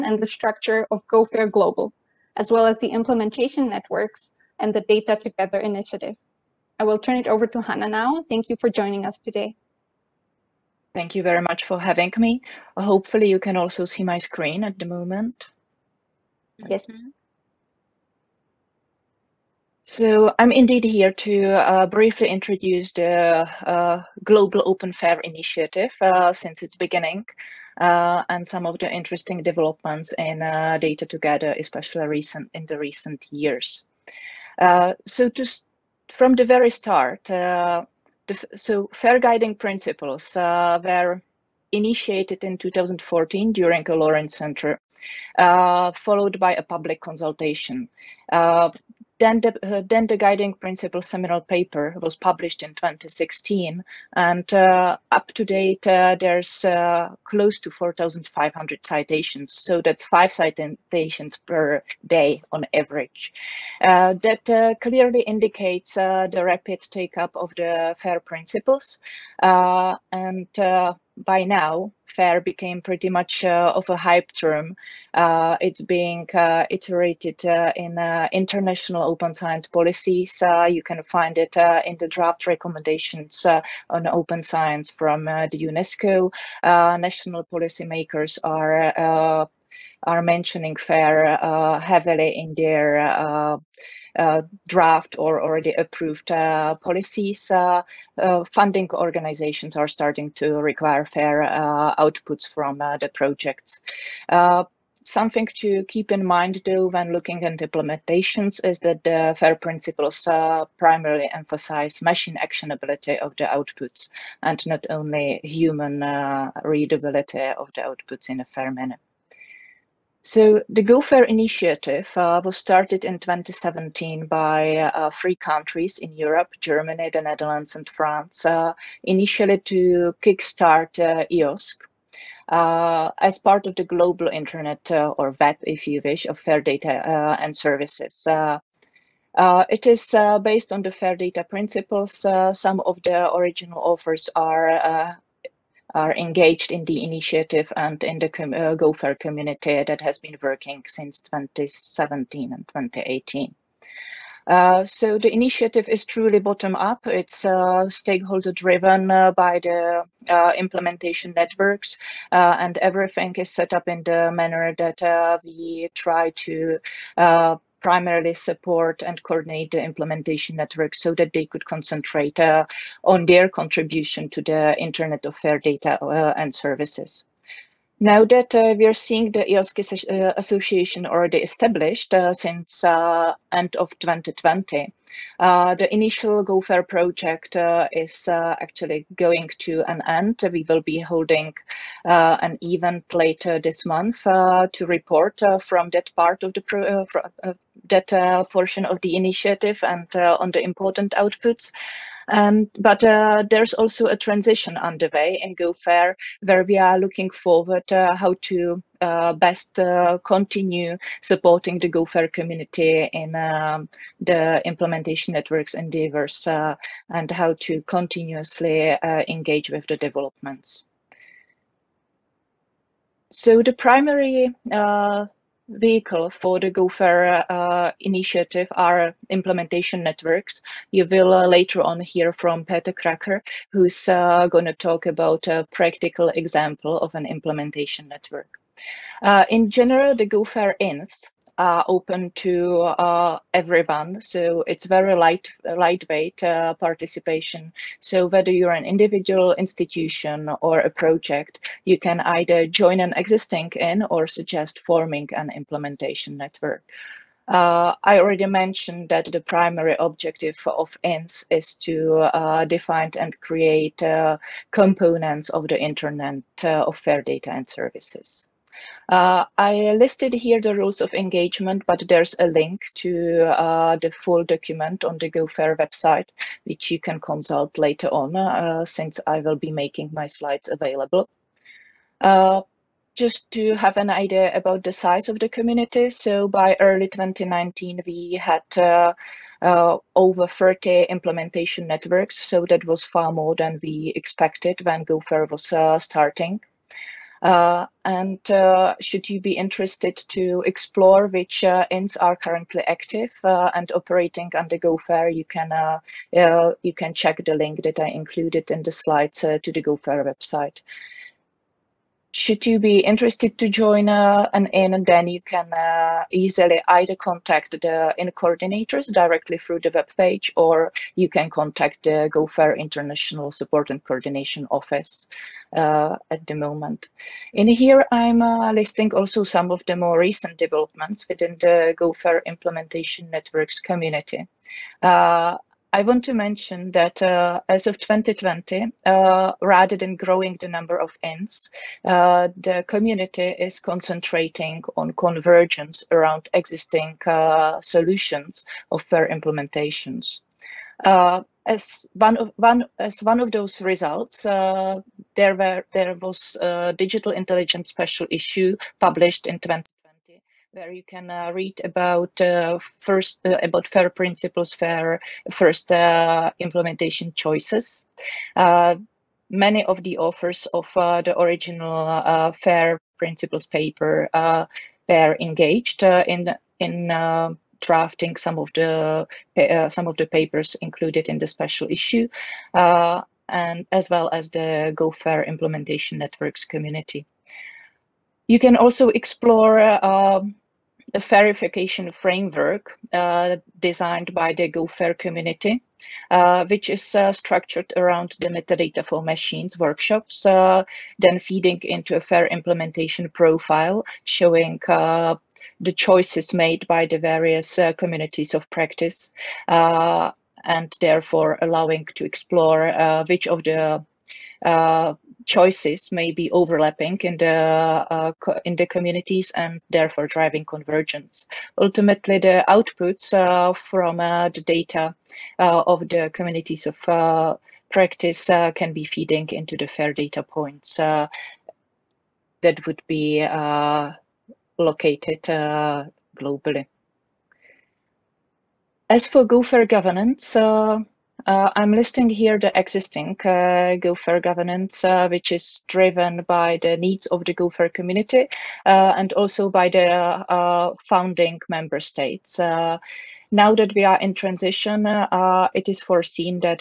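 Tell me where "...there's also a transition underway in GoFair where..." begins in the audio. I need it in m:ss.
3:23.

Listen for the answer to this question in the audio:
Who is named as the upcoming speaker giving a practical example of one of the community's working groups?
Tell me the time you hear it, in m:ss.
3:52.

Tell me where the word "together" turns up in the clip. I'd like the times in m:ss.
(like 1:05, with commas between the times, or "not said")
0:05, 0:31.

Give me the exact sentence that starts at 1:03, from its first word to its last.
Uh, that clearly indicates the rapid take up of the FAIR principles.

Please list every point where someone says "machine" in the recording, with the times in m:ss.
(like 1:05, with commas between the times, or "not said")
1:51, 6:39.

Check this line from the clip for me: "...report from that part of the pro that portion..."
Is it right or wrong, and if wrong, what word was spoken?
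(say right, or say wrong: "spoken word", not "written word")
right.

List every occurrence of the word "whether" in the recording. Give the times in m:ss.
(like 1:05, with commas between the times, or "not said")
4:08.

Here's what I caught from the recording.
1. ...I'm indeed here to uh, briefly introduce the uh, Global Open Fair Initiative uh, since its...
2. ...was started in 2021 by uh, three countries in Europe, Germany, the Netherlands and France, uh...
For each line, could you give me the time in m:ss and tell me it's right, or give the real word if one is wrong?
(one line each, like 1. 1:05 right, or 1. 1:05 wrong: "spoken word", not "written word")
1. 0:20 right
2. 2:02 wrong: "2017", not "2021".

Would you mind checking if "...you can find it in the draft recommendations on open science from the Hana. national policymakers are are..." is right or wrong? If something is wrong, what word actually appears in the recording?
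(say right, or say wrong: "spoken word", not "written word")
wrong: "UNESCO", not "Hana".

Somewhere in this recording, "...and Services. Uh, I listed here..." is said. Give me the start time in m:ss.
4:27.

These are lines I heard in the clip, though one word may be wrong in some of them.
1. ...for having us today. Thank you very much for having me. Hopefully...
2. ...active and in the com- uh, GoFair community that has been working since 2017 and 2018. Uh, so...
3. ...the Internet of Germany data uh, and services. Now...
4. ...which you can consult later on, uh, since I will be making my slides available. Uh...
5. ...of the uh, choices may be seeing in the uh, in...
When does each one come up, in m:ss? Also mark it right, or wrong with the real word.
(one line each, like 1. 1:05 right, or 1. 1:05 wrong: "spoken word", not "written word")
1. 0:08 wrong: "joining", not "having"
2. 2:27 wrong: "initiative", not "active"
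3. 2:54 wrong: "Fair", not "Germany"
4. 4:36 right
5. 6:53 wrong: "overlapping", not "seeing".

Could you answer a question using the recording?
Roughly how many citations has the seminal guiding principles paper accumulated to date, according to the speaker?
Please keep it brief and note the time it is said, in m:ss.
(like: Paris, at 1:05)
4,500, at 0:57.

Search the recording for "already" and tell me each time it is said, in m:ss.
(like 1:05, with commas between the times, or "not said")
1:35, 3:01, 4:18.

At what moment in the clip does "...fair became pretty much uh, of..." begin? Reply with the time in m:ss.
1:12.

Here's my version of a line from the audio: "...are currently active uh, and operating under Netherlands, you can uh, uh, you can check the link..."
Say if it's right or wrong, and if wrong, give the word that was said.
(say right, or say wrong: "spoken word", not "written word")
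wrong: "GoFair", not "Netherlands".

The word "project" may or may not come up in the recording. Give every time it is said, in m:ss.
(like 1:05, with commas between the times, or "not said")
1:43, 3:06, 4:10.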